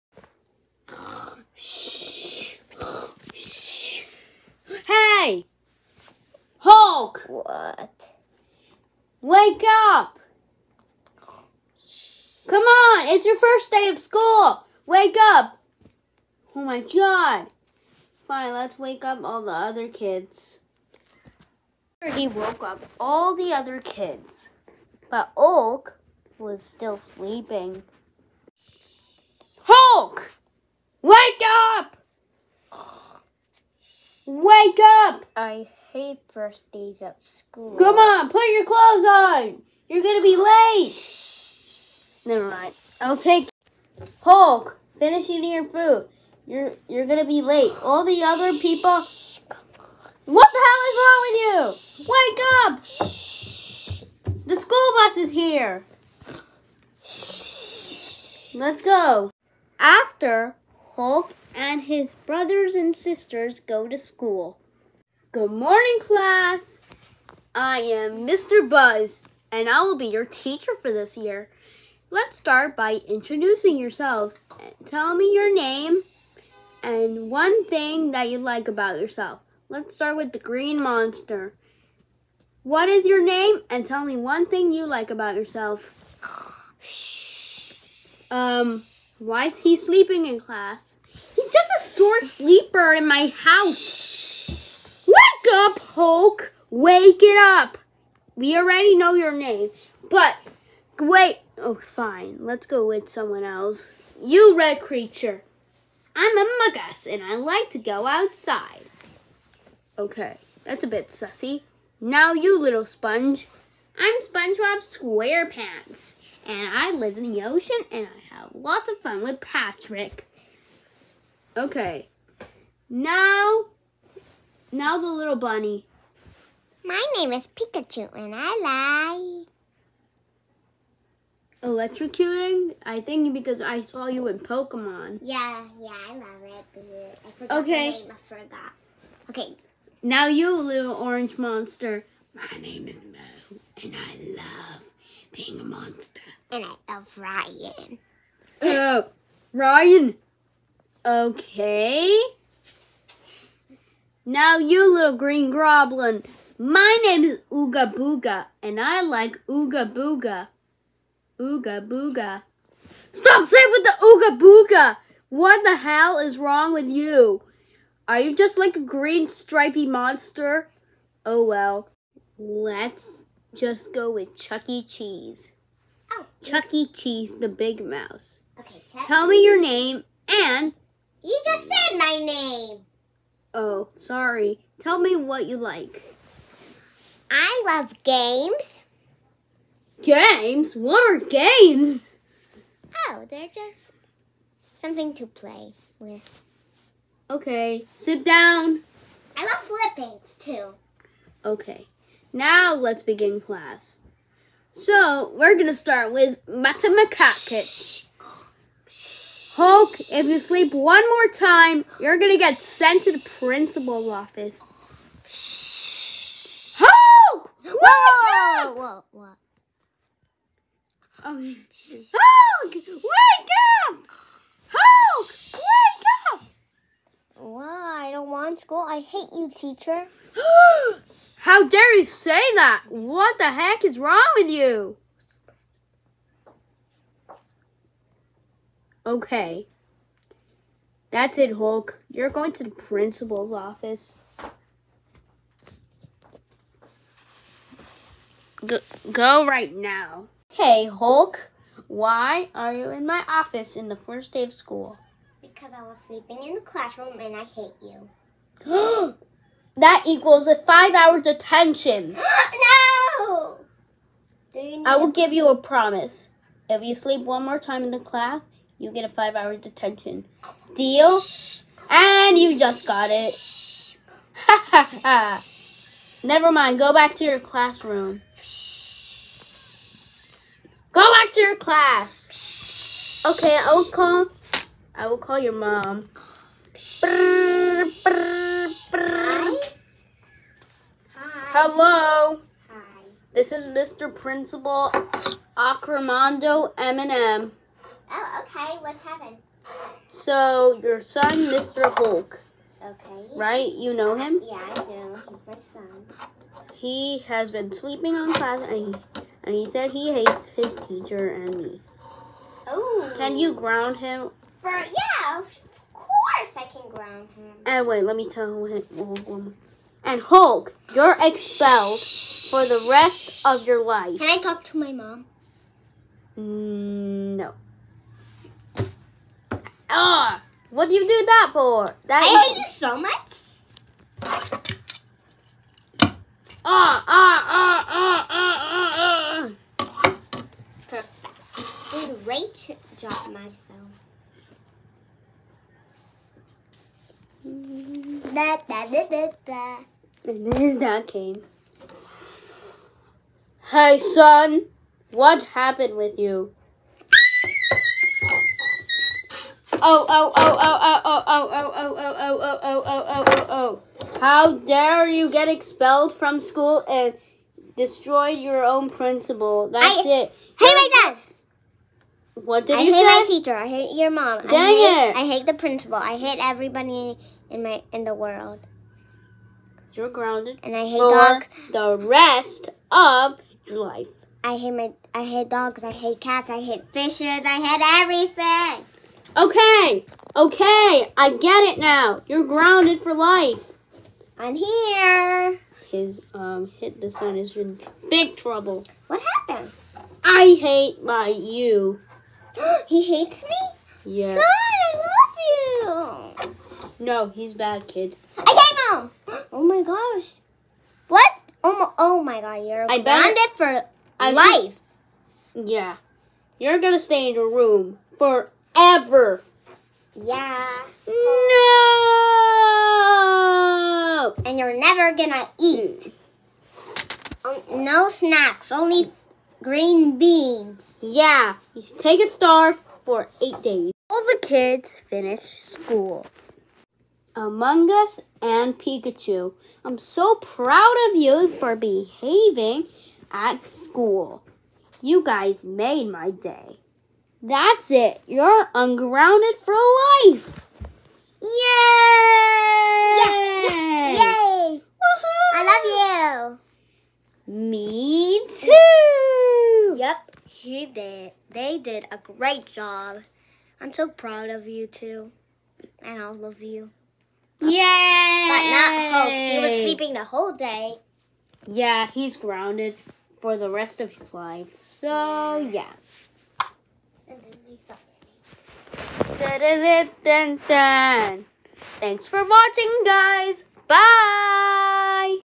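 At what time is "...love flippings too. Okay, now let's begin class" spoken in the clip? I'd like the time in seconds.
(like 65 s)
199 s.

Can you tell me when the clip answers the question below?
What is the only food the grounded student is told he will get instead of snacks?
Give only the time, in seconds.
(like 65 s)
429 s.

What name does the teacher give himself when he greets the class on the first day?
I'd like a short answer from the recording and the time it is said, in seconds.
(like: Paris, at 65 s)
Mr. Buzz, at 68 s.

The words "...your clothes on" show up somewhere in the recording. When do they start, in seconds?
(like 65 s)
38 s.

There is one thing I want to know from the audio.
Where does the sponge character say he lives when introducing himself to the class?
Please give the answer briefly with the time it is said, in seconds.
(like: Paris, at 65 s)
the ocean, at 117 s.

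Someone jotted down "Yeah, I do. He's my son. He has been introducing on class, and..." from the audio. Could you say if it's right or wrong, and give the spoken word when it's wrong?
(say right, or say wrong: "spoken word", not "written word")
wrong: "sleeping", not "introducing".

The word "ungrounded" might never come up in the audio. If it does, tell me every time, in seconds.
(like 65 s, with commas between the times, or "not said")
448 s.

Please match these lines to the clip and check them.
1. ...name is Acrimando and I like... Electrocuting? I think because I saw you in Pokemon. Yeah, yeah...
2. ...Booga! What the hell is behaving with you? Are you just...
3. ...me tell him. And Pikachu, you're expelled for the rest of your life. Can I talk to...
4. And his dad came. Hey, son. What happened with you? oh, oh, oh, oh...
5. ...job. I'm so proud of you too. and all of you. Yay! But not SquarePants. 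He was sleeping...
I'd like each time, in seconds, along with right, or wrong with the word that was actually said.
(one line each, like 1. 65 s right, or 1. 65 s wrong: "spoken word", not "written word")
1. 127 s wrong: "Pikachu", not "Acrimando"
2. 164 s wrong: "wrong", not "behaving"
3. 318 s wrong: "Hulk", not "Pikachu"
4. 350 s right
5. 462 s wrong: "Hope", not "SquarePants".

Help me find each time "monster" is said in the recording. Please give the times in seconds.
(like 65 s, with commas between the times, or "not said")
80 s, 141 s, 145 s, 169 s.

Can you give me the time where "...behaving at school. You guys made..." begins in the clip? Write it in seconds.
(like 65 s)
441 s.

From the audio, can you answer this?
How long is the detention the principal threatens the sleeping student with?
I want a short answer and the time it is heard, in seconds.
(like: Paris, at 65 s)
5 hours, at 260 s.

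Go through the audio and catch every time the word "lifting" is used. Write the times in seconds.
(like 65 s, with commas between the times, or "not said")
not said.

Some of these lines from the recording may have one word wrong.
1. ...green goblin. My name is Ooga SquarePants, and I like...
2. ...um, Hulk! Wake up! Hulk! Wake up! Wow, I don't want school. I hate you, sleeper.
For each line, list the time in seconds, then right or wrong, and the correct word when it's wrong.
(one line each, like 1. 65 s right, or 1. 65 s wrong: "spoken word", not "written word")
1. 155 s wrong: "Booga", not "SquarePants"
2. 221 s wrong: "teacher", not "sleeper".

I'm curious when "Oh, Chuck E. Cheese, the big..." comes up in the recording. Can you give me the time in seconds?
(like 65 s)
176 s.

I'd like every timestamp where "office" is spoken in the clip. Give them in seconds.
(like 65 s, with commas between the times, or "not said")
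214 s, 243 s, 253 s.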